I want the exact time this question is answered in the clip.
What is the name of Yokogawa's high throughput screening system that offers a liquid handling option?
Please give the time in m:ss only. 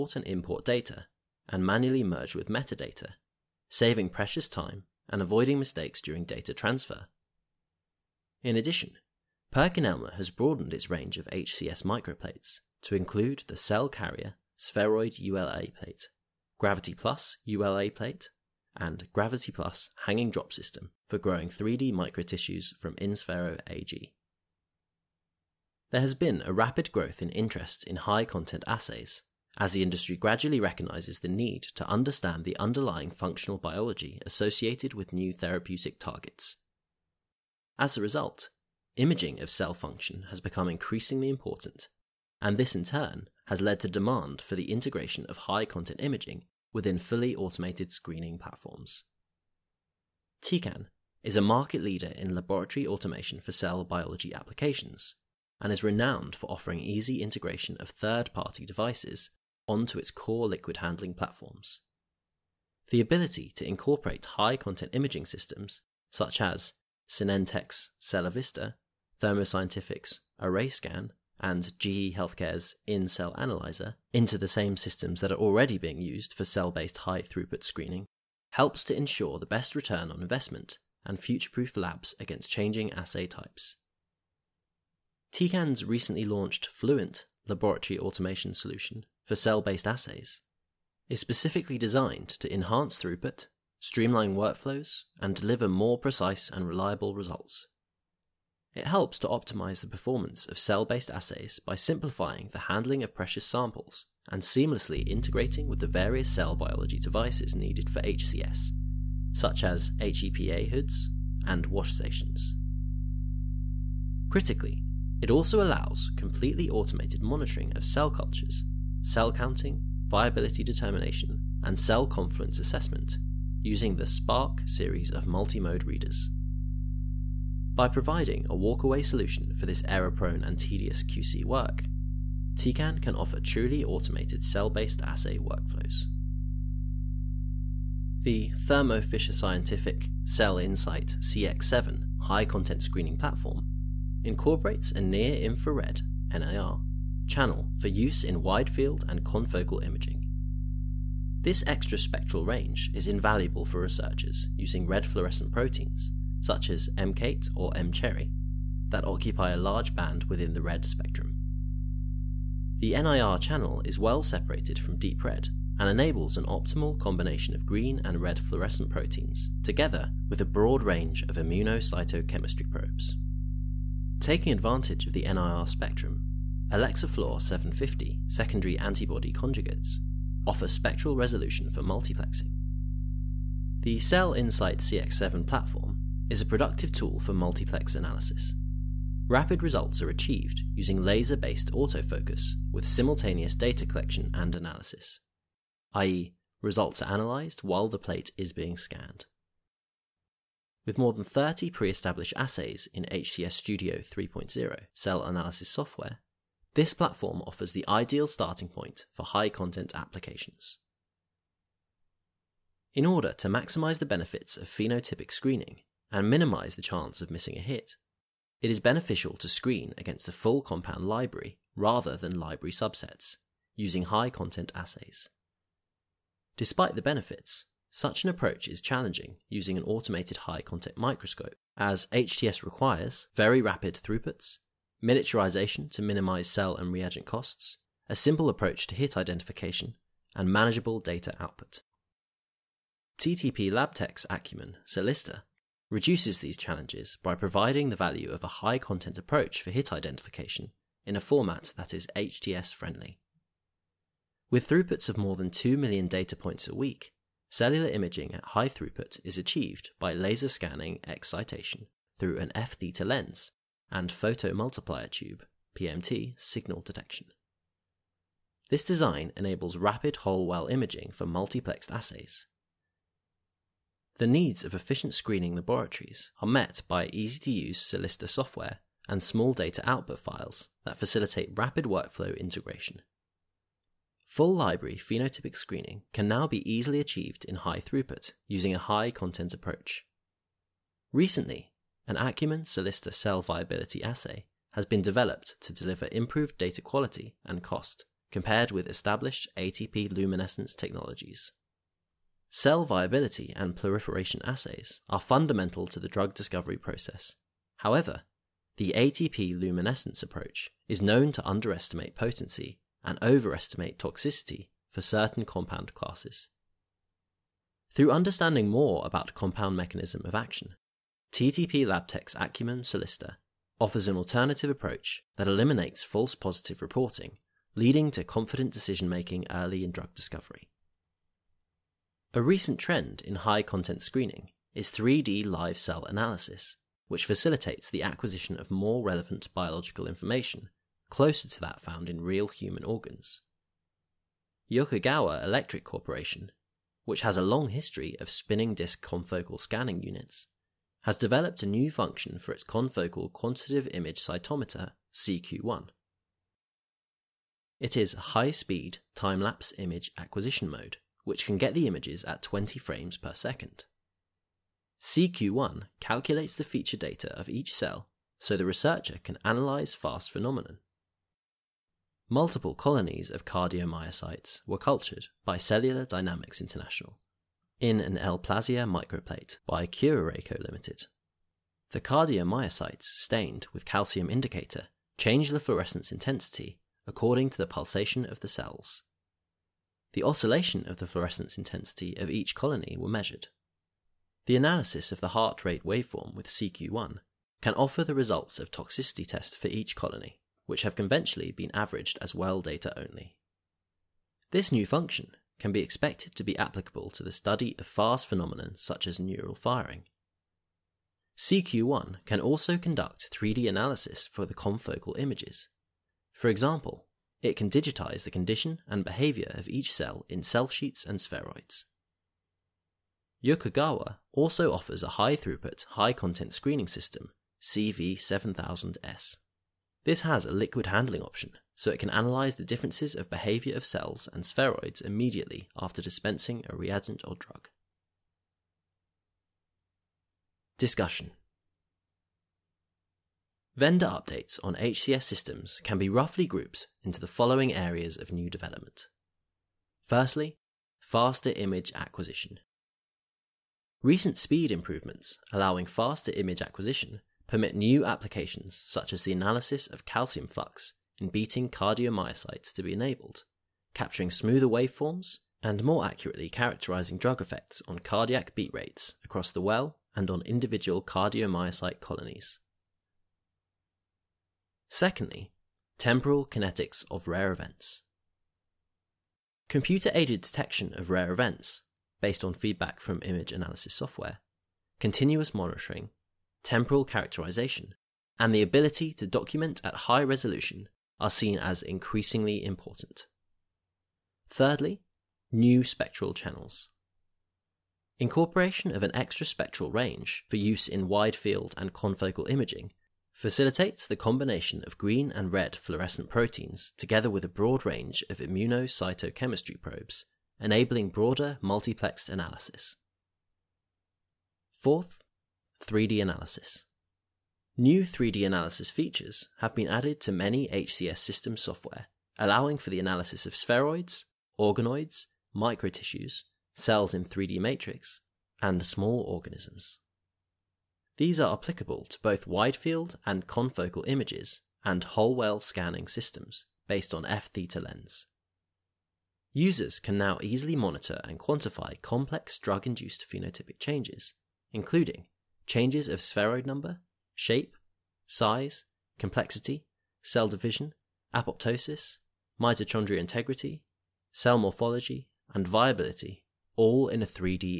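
7:07.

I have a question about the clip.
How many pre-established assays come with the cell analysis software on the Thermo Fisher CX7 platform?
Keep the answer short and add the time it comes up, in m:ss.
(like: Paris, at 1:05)
More than 30, at 3:20.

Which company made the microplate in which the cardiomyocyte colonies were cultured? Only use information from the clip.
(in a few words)
Kuraray.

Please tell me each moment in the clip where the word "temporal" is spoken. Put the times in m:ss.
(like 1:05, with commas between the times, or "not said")
7:55, 8:06.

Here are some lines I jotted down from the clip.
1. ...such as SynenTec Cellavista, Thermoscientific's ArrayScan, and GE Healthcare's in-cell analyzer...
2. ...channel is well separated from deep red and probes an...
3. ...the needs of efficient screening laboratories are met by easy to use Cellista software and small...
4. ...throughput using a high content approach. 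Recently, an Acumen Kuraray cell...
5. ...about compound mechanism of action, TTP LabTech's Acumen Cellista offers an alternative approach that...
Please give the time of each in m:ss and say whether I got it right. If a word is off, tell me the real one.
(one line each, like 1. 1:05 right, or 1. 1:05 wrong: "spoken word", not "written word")
1. 1:06 right
2. 2:43 wrong: "enables", not "probes"
3. 4:34 right
4. 4:47 wrong: "Cellista", not "Kuraray"
5. 5:19 right.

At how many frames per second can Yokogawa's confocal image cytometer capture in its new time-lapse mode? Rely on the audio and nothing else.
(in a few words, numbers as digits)
20.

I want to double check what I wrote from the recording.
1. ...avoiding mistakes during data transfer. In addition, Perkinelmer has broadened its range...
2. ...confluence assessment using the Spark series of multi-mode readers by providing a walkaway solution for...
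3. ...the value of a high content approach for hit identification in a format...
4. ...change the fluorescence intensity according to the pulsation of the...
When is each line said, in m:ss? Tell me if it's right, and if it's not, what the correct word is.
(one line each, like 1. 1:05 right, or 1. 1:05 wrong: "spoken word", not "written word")
1. 0:05 right
2. 2:02 right
3. 4:07 right
4. 6:25 right.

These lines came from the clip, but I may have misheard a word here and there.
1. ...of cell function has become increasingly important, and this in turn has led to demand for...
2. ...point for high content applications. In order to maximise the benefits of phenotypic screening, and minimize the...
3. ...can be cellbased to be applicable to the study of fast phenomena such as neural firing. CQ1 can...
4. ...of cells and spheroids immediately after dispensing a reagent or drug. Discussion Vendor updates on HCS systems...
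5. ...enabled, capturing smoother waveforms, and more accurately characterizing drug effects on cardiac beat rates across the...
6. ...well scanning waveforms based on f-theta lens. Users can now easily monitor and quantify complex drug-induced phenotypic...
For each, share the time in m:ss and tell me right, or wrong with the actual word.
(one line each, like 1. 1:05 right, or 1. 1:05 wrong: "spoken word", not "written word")
1. 0:39 right
2. 3:28 right
3. 6:45 wrong: "expected", not "cellbased"
4. 7:13 right
5. 7:42 right
6. 8:55 wrong: "systems", not "waveforms".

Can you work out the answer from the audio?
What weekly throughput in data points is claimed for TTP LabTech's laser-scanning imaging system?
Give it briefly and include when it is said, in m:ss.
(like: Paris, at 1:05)
More than 2 million, at 4:15.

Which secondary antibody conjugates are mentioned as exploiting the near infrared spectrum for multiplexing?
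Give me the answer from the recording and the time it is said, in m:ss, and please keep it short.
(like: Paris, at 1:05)
Fluor 750, at 2:56.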